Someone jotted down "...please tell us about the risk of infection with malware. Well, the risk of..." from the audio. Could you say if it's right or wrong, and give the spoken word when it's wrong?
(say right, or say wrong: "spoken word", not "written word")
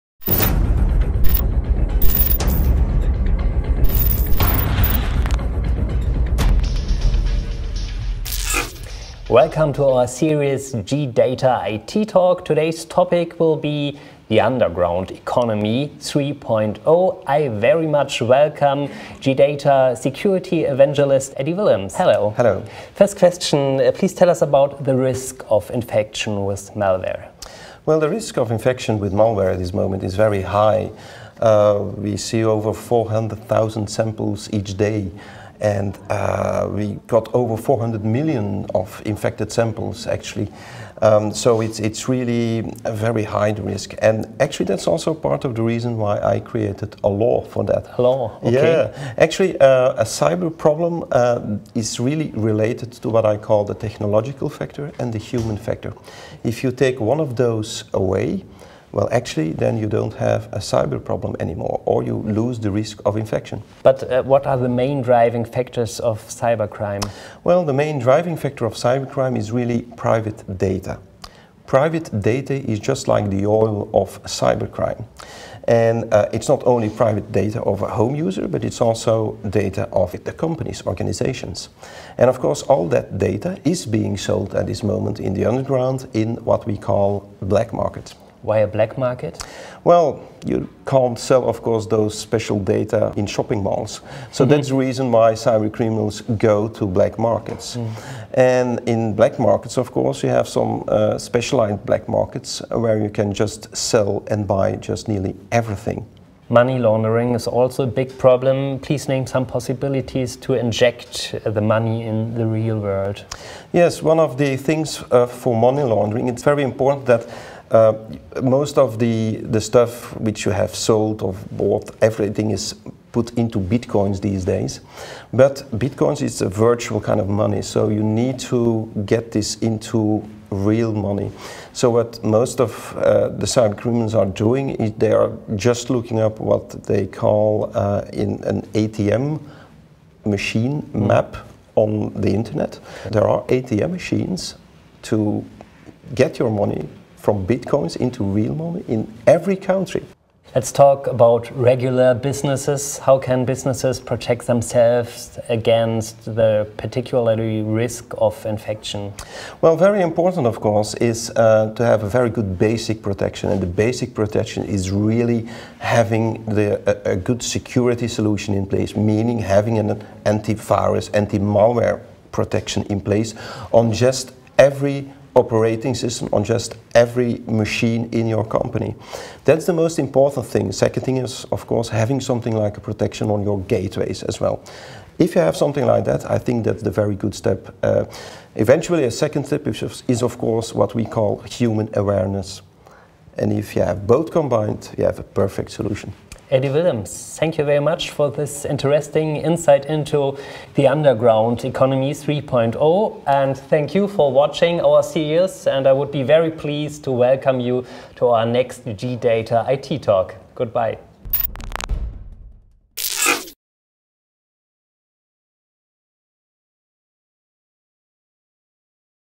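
right.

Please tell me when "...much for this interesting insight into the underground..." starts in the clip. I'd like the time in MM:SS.
03:17.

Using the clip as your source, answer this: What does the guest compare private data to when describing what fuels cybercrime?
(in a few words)
The oil of cybercrime.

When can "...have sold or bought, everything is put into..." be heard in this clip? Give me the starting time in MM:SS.
02:00.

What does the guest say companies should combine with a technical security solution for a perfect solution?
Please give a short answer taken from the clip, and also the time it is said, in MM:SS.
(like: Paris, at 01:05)
Human awareness, at 03:11.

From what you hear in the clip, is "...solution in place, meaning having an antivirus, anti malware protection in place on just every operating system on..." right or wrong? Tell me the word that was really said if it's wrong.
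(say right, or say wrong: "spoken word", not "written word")
right.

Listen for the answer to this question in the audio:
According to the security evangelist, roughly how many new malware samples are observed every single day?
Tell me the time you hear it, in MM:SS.
00:32.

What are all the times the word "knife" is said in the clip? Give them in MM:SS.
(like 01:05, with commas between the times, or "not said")
not said.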